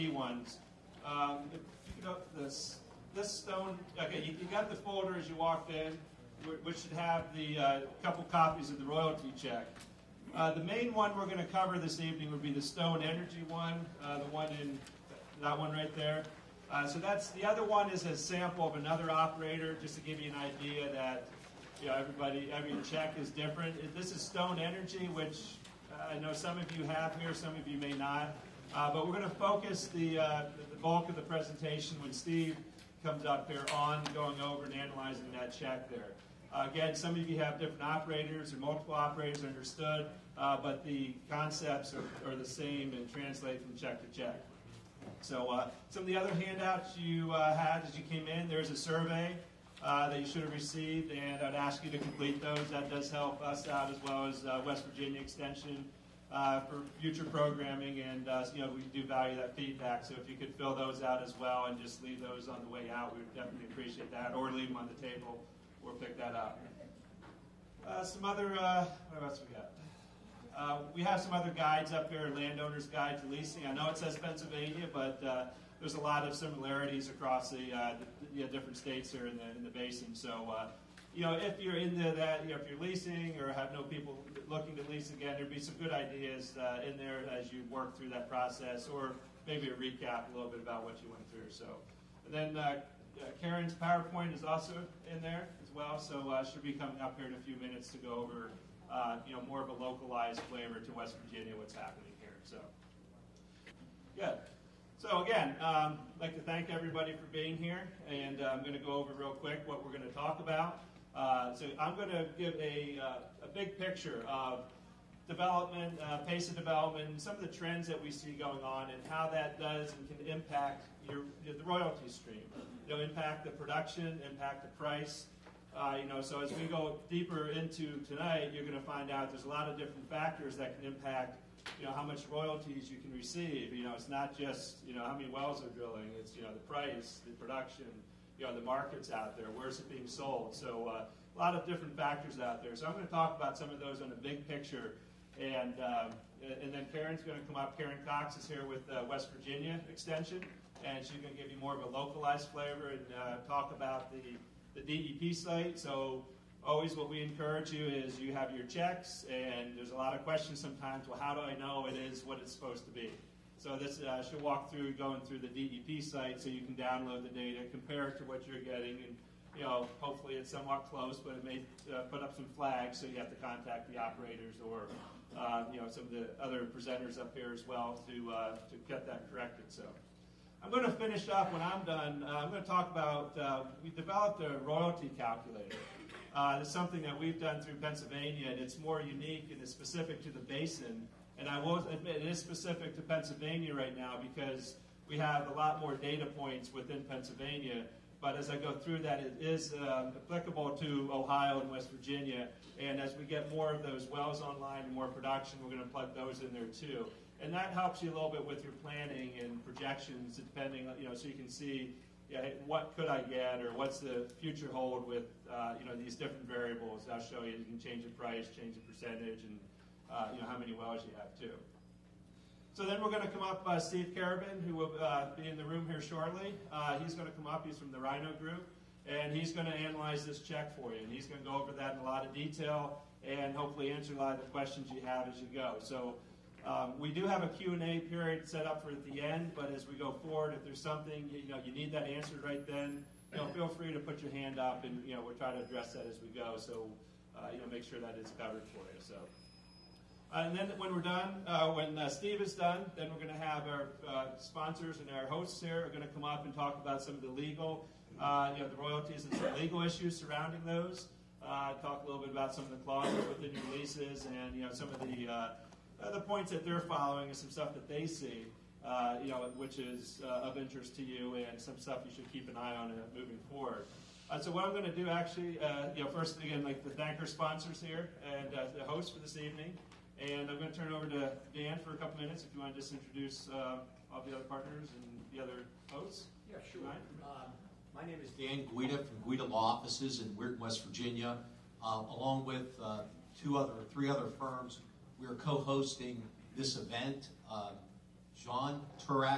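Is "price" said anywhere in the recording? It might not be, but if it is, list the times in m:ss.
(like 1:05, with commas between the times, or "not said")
2:04, 2:16, 3:38.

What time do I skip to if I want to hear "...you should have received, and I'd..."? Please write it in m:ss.
0:50.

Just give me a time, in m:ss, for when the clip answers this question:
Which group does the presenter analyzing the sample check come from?
3:47.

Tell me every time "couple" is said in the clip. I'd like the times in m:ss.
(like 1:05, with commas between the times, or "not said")
0:08, 4:41.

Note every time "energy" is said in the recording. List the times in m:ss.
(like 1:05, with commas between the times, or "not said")
0:13, 0:24.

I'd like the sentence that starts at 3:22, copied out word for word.
And as we get more of those wells online and more production, we're going to plug those in there too.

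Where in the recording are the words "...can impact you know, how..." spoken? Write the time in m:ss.
2:10.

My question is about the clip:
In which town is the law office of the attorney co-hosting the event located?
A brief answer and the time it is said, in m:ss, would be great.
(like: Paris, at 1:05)
Weirton, West Virginia, at 4:50.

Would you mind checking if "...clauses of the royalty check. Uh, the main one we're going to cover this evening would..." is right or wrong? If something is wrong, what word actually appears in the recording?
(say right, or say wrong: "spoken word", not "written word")
wrong: "copies", not "clauses".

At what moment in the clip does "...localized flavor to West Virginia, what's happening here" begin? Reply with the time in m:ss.
1:39.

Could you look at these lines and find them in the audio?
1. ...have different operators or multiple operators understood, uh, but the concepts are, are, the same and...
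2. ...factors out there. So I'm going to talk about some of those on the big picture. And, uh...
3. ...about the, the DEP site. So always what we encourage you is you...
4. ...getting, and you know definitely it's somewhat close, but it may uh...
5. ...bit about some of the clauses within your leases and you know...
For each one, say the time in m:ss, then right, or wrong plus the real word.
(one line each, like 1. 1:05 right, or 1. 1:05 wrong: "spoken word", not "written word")
1. 0:37 right
2. 2:21 right
3. 2:33 right
4. 2:48 wrong: "hopefully", not "definitely"
5. 4:22 right.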